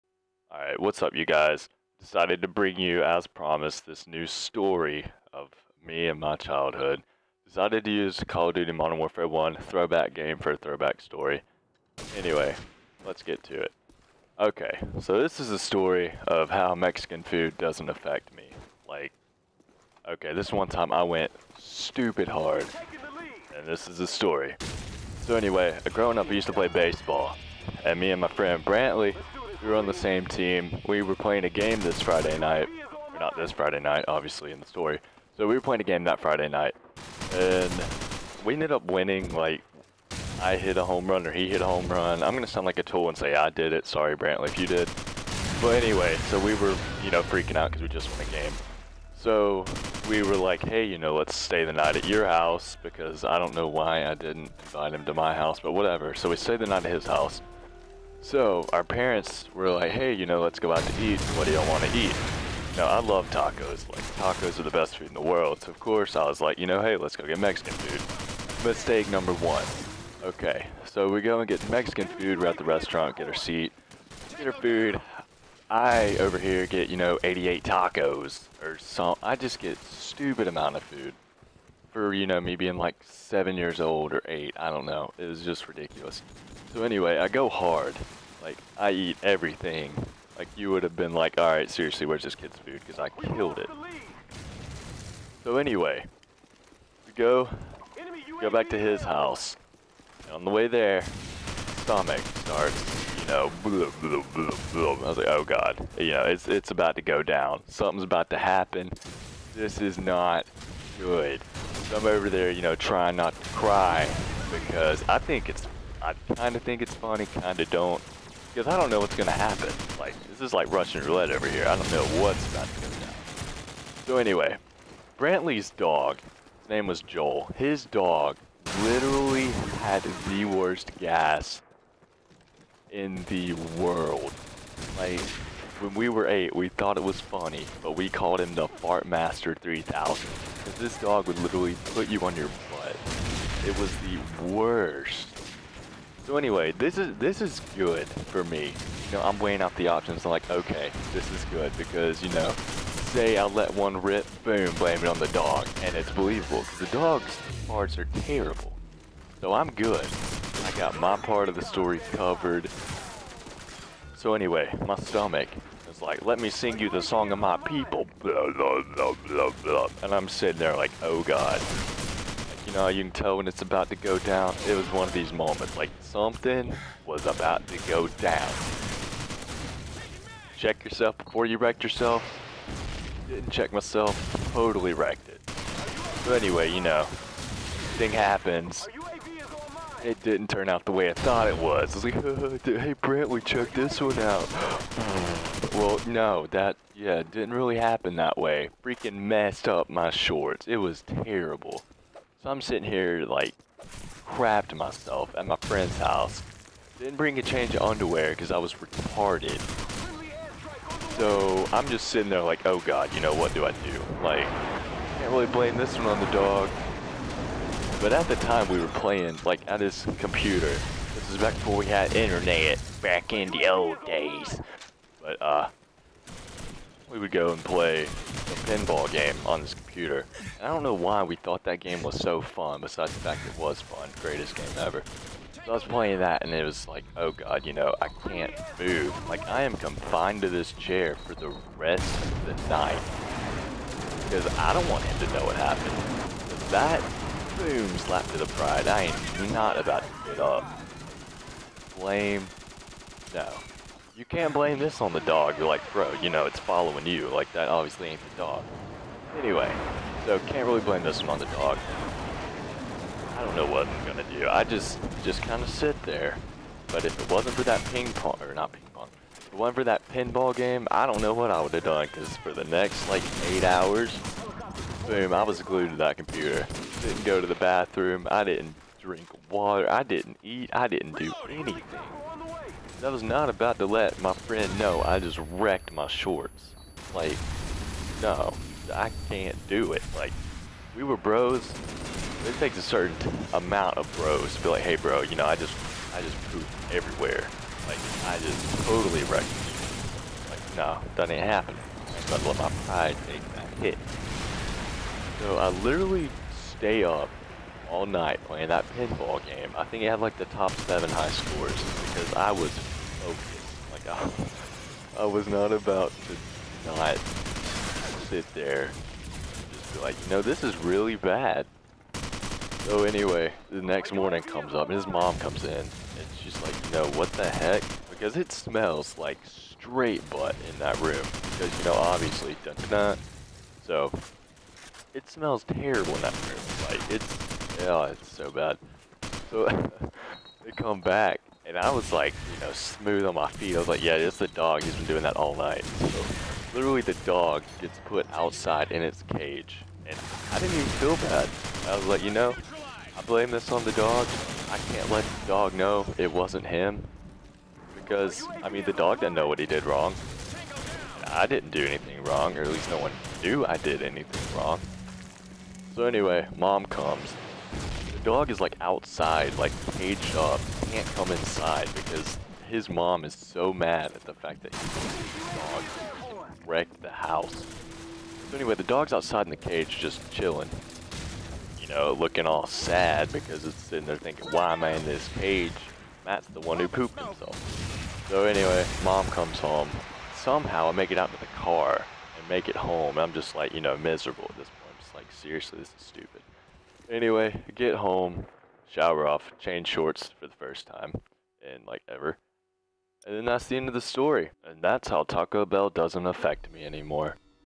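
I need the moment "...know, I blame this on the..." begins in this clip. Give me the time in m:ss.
5:52.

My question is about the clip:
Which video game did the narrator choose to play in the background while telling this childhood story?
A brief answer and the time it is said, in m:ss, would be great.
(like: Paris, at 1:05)
Call of Duty Modern Warfare 1, at 0:08.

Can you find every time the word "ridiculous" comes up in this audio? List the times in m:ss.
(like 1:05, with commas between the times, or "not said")
1:25.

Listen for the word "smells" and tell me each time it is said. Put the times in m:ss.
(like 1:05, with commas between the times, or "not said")
5:28, 5:35.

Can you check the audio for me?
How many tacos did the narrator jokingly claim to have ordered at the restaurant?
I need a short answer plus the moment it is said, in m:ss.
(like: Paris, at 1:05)
88, at 1:17.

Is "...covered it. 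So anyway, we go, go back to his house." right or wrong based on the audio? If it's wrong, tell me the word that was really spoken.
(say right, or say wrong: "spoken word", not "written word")
wrong: "killed", not "covered".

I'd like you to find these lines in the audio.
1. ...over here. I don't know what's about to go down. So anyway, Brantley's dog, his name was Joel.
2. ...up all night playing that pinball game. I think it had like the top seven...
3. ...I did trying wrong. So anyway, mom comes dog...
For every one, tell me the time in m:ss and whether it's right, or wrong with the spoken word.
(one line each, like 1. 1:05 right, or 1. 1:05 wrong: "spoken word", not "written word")
1. 2:01 right
2. 5:07 right
3. 6:03 wrong: "anything", not "trying".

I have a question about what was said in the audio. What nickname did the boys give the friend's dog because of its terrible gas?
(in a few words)
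Fart Master 3000.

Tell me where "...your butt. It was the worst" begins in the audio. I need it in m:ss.
2:22.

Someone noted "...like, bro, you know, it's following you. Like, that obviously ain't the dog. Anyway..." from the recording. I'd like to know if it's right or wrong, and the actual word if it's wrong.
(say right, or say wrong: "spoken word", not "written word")
right.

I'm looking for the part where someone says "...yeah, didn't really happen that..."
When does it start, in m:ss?
3:16.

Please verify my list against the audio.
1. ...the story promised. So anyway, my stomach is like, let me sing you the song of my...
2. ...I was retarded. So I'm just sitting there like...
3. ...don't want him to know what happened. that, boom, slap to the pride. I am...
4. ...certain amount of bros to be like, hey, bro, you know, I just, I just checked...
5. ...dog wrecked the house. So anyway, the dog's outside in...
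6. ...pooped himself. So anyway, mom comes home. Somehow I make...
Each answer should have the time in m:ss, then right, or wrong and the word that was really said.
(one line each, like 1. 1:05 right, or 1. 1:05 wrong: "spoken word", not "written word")
1. 2:41 wrong: "covered", not "promised"
2. 3:28 right
3. 4:04 right
4. 4:52 wrong: "pooped", not "checked"
5. 6:15 right
6. 6:26 right.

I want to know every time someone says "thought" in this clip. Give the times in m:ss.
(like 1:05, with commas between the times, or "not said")
2:16, 3:11, 3:51.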